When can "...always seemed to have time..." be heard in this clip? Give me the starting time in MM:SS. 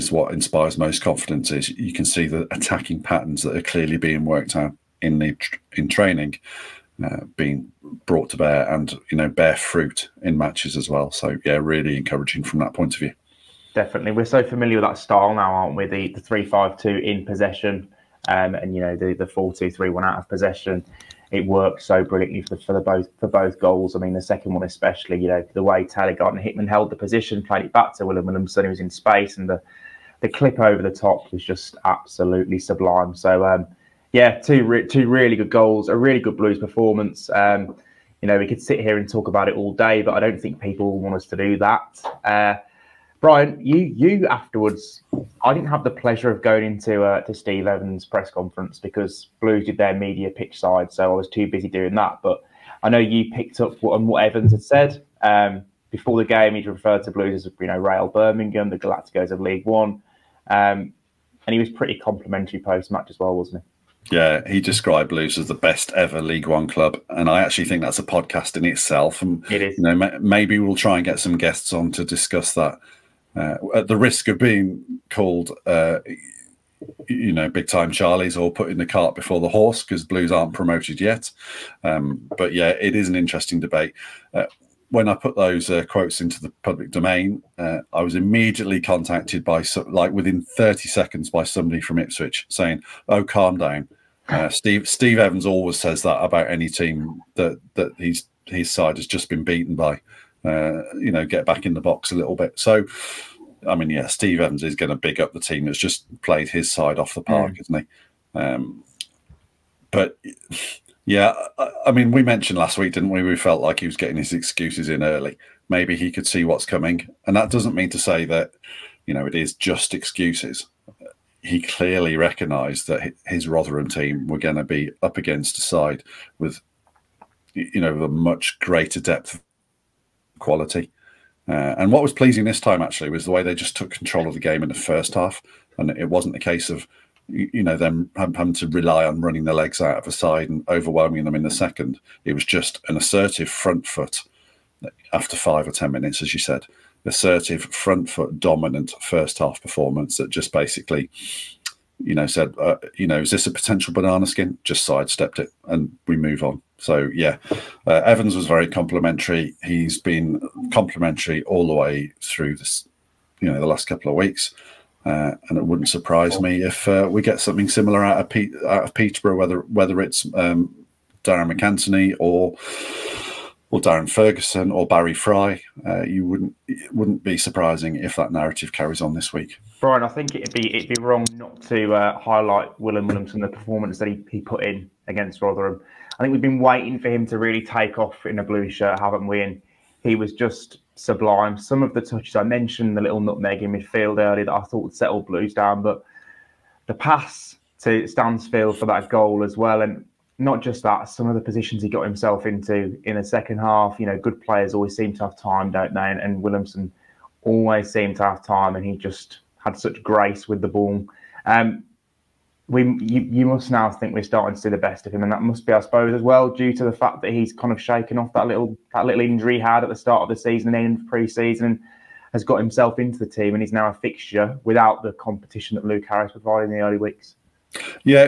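03:27.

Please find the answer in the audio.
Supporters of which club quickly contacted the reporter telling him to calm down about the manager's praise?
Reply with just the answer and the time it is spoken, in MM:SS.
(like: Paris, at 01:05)
Ipswich, at 01:31.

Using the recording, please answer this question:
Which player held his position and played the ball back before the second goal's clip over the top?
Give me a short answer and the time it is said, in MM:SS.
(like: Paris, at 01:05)
Taylor Gardner-Hickman, at 00:25.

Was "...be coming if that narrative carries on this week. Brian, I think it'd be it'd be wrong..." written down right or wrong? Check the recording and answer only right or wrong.
wrong.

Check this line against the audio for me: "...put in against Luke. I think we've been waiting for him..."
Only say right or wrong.
wrong.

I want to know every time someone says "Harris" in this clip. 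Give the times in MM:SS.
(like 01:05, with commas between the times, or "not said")
03:46.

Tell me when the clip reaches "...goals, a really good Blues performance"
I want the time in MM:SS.
00:35.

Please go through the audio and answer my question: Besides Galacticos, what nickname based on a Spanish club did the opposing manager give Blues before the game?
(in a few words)
Real Birmingham.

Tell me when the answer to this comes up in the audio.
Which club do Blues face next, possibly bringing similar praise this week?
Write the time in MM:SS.
02:48.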